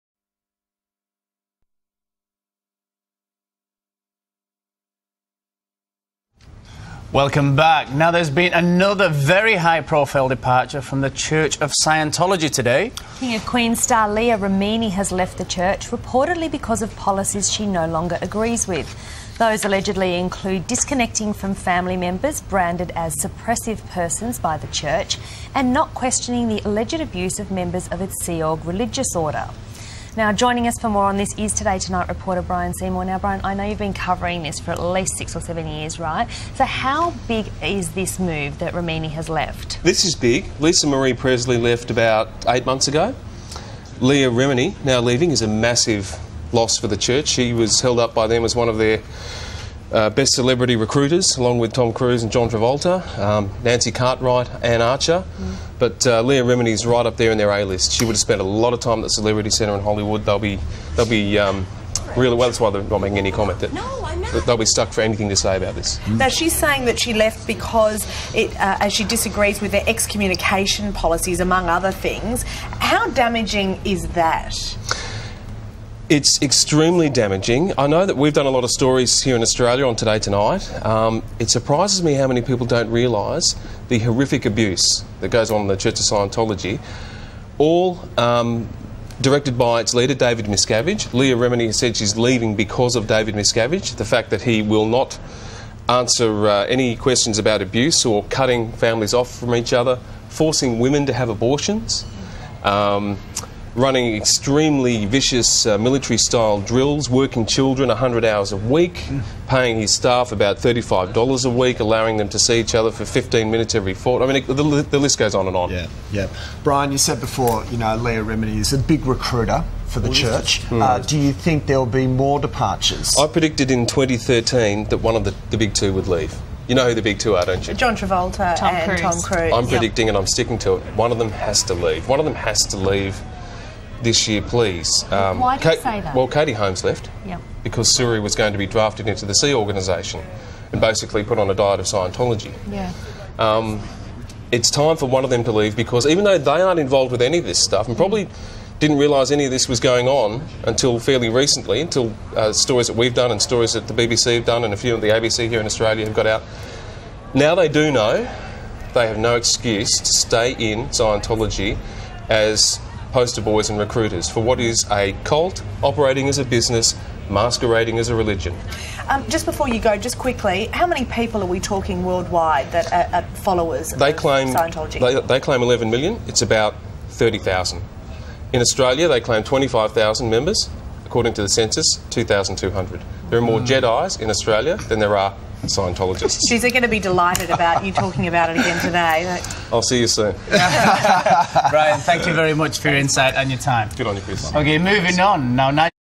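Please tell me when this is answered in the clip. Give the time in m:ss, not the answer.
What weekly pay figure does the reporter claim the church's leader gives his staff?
1:50.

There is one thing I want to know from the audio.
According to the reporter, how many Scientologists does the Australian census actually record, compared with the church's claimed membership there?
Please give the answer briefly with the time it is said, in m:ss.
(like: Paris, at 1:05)
2,200, at 3:02.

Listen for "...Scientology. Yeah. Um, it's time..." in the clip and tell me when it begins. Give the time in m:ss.
2:21.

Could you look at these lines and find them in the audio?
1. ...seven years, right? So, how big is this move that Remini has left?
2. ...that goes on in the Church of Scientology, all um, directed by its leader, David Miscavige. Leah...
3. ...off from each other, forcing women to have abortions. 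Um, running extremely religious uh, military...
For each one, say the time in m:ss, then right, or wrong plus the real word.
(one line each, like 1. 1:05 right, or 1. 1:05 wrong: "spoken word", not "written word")
1. 0:35 right
2. 1:25 right
3. 1:39 wrong: "vicious", not "religious".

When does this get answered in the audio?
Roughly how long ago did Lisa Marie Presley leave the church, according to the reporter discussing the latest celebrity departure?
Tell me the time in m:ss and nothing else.
0:42.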